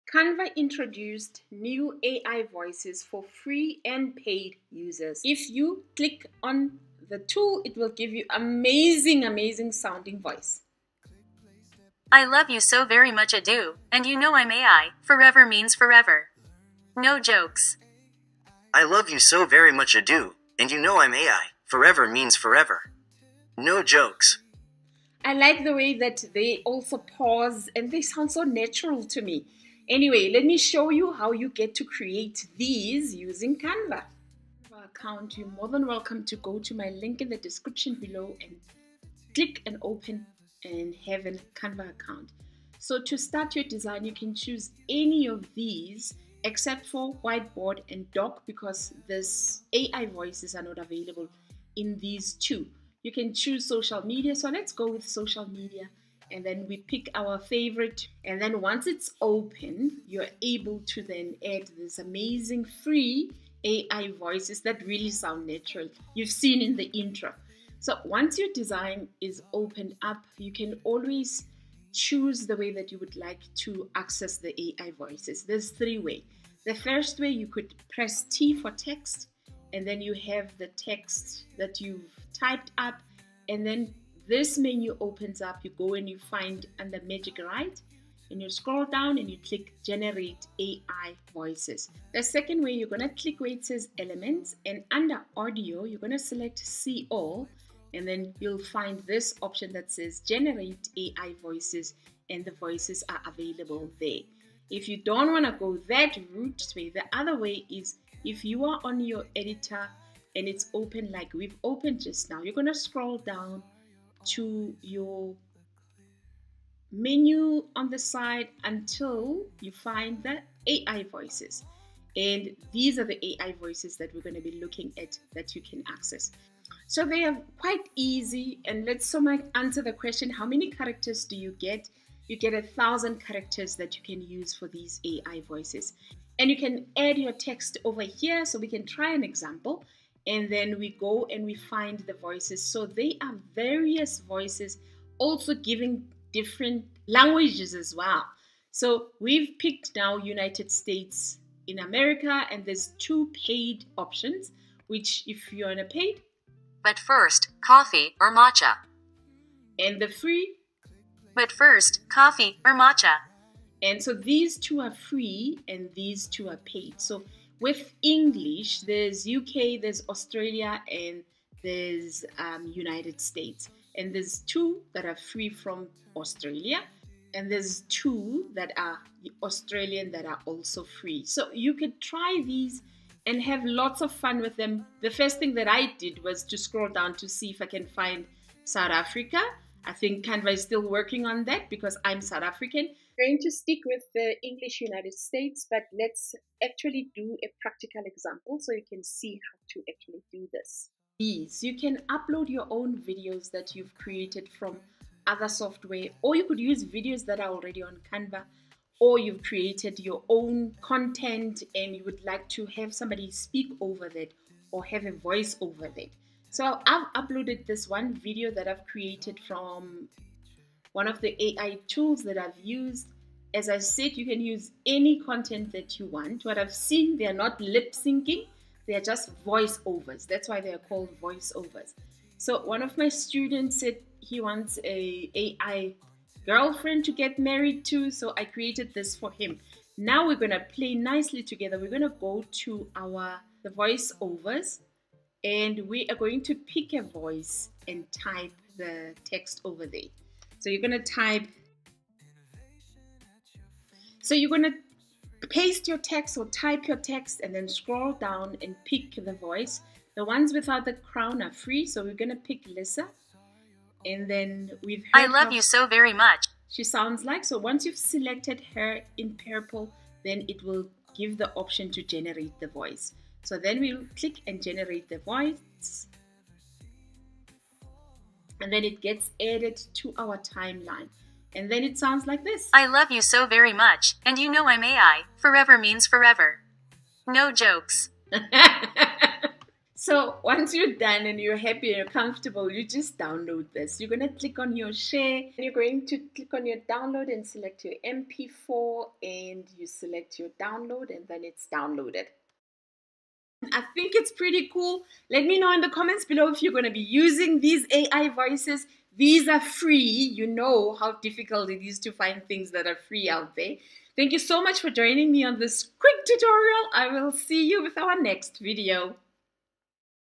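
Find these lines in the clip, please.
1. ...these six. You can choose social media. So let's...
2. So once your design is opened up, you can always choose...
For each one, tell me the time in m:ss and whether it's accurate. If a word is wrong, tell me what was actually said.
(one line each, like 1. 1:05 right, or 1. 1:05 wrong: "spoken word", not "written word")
1. 0:51 wrong: "two", not "six"
2. 1:07 right.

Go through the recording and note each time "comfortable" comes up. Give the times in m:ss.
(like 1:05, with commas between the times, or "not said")
4:52.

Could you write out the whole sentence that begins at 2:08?
And let's so much answer the question how many characters do you get?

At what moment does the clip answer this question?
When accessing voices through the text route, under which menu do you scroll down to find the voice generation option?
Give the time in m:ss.
1:27.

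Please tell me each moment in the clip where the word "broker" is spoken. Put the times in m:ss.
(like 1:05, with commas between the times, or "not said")
not said.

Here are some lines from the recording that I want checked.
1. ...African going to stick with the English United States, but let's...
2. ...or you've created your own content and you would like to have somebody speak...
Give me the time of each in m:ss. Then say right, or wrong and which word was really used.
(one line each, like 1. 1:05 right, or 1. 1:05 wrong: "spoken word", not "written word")
1. 3:12 right
2. 3:28 right.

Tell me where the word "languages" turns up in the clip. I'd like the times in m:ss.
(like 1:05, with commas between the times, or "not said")
2:27.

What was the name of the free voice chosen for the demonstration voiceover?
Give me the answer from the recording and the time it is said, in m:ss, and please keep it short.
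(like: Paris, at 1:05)
Lissa, at 4:22.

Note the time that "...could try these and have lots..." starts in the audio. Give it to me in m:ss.
3:01.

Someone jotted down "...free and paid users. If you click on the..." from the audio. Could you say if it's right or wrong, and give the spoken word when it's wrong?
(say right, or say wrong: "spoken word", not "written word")
right.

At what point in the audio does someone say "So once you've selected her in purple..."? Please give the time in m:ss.
4:27.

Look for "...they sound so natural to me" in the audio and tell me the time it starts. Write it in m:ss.
0:27.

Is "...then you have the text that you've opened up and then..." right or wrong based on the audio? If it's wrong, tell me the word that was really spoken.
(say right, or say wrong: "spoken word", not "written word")
wrong: "typed", not "opened".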